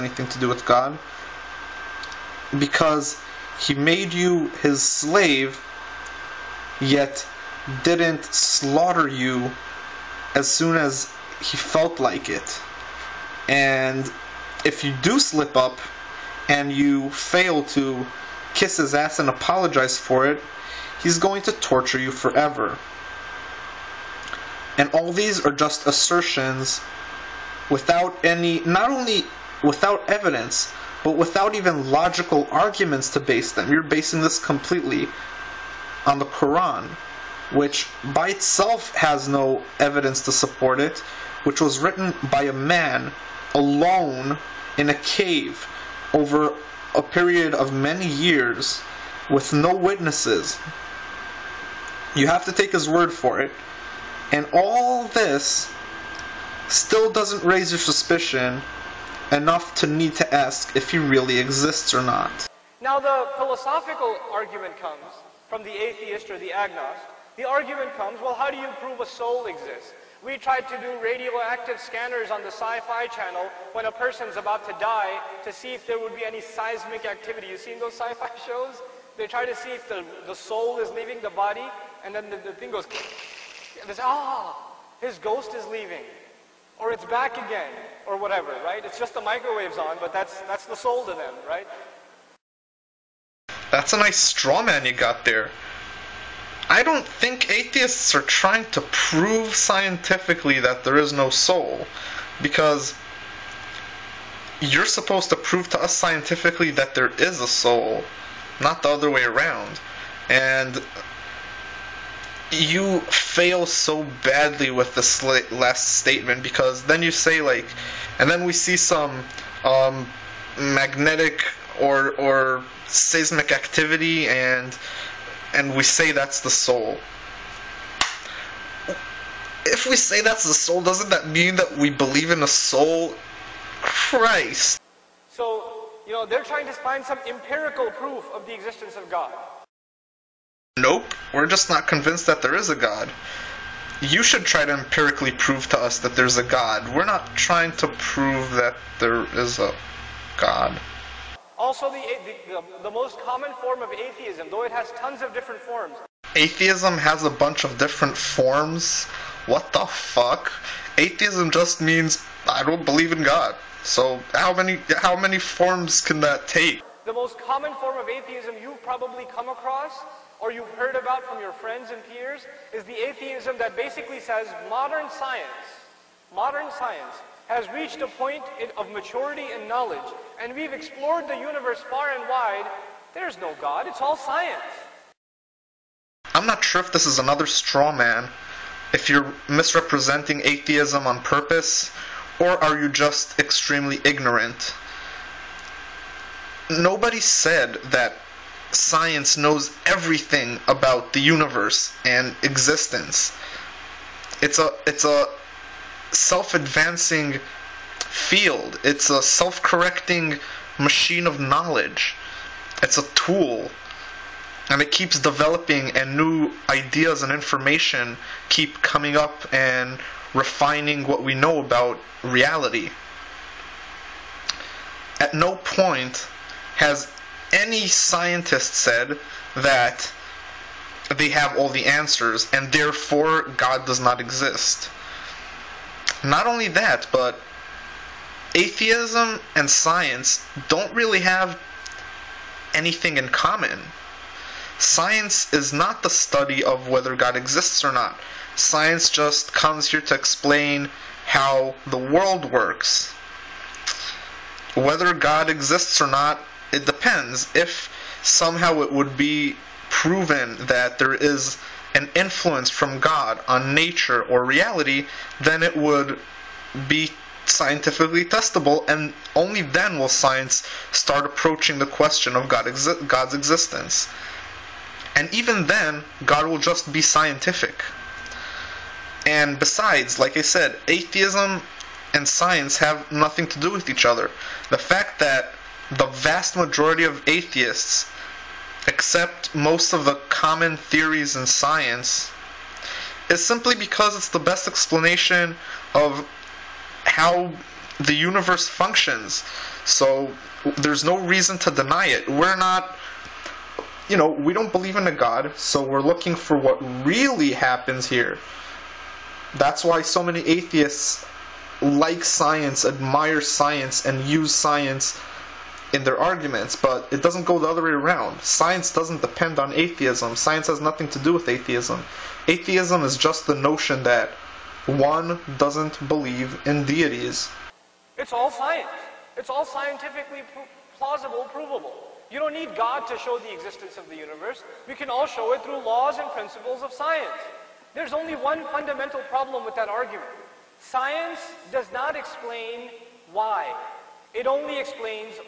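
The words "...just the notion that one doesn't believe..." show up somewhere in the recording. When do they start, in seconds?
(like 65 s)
323 s.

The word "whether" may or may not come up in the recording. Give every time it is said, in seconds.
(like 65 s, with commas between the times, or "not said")
246 s, 254 s.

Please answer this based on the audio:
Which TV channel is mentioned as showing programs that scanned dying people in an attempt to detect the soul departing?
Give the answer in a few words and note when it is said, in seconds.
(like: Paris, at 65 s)
Sci-Fi channel, at 72 s.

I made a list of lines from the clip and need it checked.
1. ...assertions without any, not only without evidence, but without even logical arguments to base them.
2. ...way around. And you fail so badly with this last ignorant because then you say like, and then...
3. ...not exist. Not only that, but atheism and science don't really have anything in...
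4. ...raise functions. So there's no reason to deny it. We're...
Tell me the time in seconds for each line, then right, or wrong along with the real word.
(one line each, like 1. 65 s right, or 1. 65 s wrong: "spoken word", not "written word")
1. 25 s right
2. 109 s wrong: "statement", not "ignorant"
3. 234 s right
4. 298 s wrong: "universe", not "raise".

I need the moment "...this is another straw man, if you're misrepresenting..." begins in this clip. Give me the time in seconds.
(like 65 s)
186 s.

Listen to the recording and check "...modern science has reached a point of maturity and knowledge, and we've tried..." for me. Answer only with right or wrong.
wrong.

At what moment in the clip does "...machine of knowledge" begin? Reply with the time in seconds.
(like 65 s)
210 s.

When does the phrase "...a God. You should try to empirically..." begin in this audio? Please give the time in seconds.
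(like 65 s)
142 s.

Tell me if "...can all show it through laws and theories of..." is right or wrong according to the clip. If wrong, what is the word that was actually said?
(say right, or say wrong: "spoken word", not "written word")
wrong: "principles", not "theories".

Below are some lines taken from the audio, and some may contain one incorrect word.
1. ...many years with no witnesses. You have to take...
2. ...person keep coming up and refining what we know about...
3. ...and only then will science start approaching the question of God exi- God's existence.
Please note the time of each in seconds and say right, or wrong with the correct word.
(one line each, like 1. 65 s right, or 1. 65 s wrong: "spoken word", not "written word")
1. 47 s right
2. 217 s wrong: "information", not "person"
3. 268 s right.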